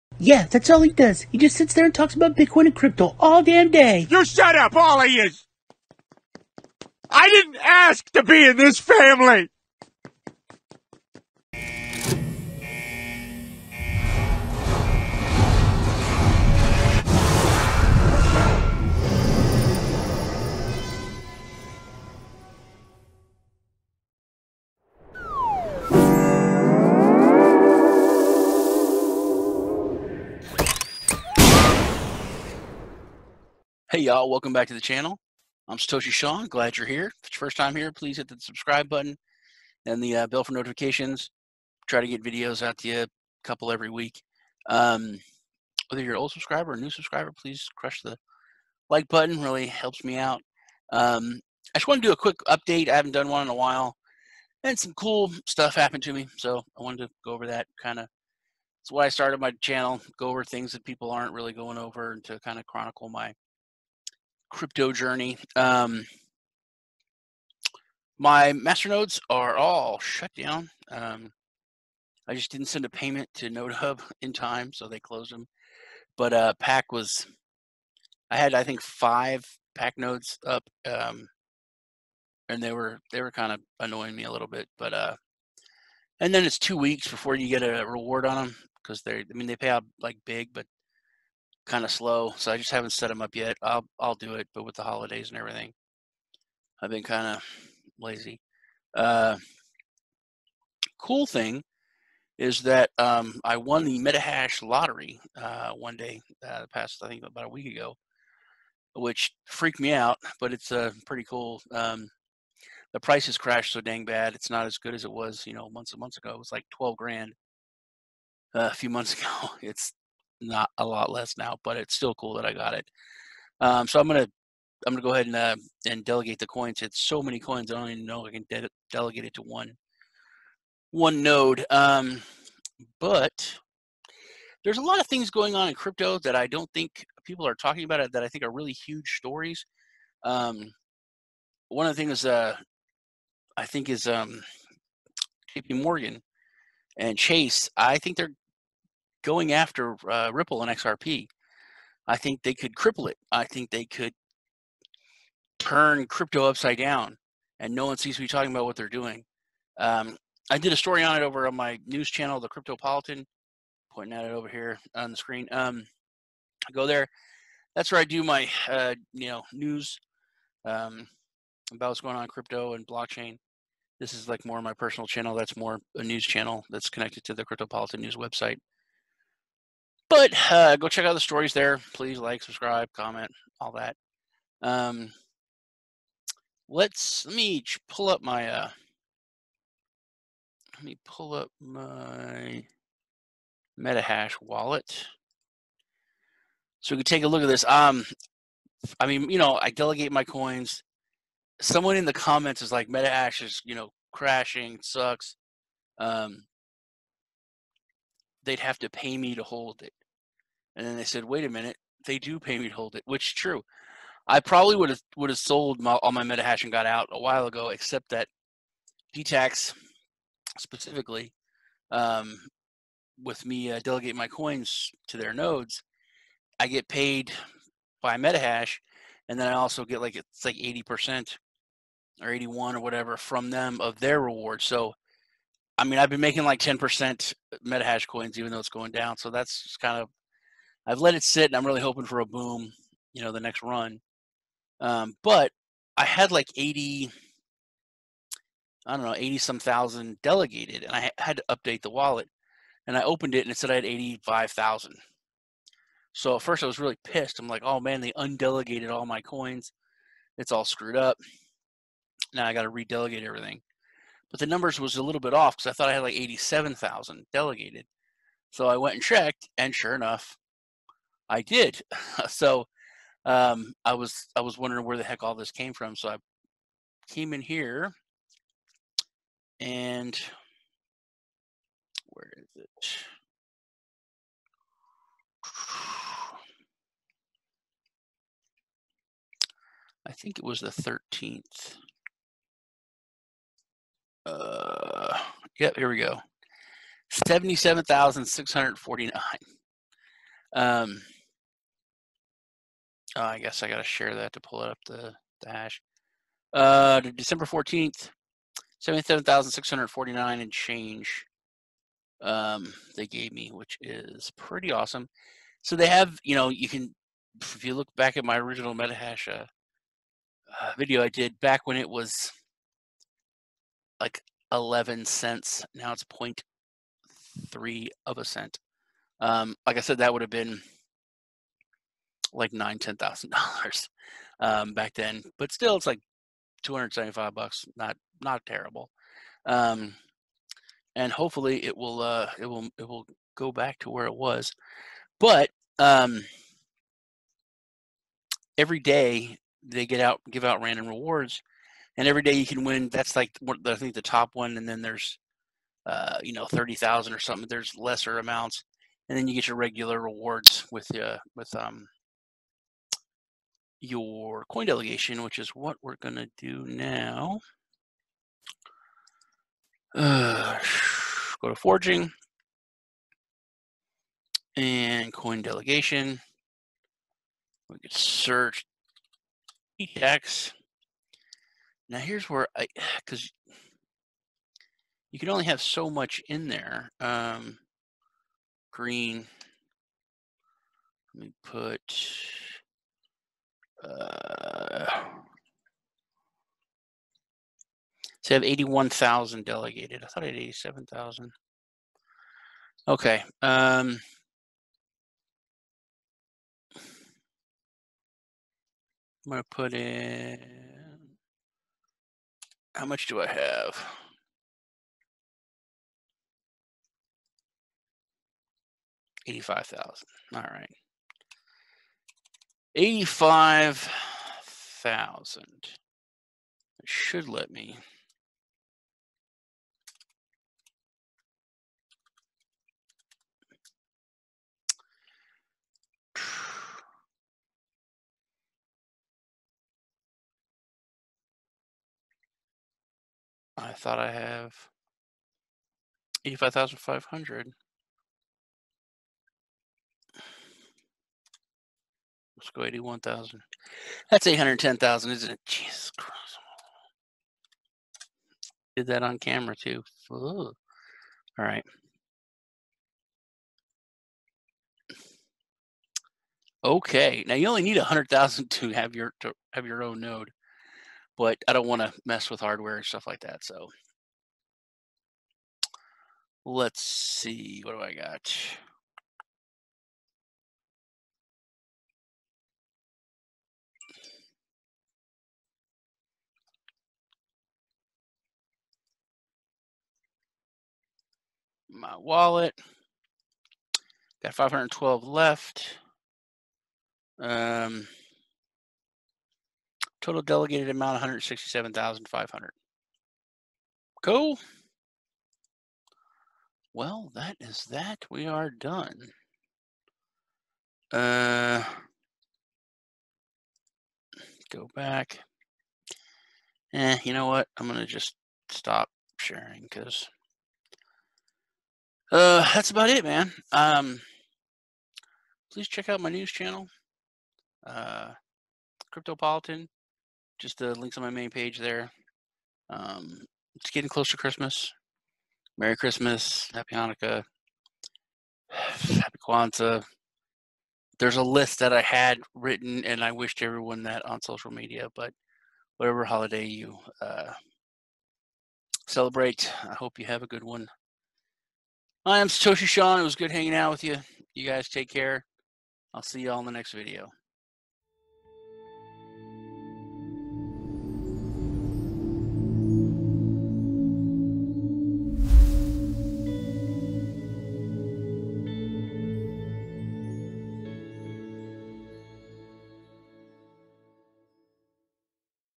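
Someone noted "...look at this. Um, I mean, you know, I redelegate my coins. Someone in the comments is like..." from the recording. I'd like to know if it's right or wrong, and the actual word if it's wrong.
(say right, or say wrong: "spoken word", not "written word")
wrong: "delegate", not "redelegate".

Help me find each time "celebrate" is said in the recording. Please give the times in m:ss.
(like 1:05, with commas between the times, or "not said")
9:08.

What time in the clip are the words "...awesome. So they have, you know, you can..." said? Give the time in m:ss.
5:14.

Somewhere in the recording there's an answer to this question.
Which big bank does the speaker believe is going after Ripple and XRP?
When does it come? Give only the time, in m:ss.
2:25.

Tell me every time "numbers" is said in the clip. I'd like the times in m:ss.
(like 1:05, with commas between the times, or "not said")
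4:24.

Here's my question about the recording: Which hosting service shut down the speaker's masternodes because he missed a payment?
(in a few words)
NodeHub.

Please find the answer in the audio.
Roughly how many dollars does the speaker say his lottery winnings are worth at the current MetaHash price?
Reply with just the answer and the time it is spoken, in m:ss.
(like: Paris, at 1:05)
$275, at 5:36.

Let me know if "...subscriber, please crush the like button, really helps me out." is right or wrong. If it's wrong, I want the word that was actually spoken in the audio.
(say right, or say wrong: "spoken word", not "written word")
right.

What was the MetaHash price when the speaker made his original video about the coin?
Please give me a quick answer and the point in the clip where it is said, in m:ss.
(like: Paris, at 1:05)
11 cents, at 5:24.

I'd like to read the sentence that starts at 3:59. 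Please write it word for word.
So that's kind of I've let it sit, and I'm really hoping for a boom, you know, the next run.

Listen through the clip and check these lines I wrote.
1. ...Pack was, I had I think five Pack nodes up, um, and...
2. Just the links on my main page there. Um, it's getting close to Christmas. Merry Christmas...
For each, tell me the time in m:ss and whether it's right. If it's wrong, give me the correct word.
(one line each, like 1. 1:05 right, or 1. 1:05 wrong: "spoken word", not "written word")
1. 1:16 right
2. 8:50 right.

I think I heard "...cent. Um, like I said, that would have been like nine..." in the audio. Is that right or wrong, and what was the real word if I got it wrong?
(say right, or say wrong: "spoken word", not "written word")
right.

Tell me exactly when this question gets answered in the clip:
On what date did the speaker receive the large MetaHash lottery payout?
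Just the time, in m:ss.
5:07.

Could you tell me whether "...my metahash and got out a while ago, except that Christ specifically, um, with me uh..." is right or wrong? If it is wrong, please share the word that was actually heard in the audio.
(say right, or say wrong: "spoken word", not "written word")
wrong: "Detax", not "Christ".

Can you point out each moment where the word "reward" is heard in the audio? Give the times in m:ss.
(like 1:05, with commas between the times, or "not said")
1:27, 3:54, 5:50, 5:59.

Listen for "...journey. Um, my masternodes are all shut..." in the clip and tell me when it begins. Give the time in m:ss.
1:04.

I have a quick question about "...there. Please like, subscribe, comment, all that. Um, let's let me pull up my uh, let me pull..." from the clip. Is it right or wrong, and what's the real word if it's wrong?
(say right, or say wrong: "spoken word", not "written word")
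right.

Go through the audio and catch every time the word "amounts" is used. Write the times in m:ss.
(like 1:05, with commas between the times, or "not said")
5:58, 8:20.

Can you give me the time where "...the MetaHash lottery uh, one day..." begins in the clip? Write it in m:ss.
1:43.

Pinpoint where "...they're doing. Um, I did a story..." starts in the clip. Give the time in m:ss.
2:38.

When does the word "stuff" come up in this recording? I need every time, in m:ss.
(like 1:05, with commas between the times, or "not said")
0:55, 7:52.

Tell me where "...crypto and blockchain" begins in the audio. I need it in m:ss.
2:52.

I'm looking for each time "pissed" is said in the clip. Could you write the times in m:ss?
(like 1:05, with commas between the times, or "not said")
4:17.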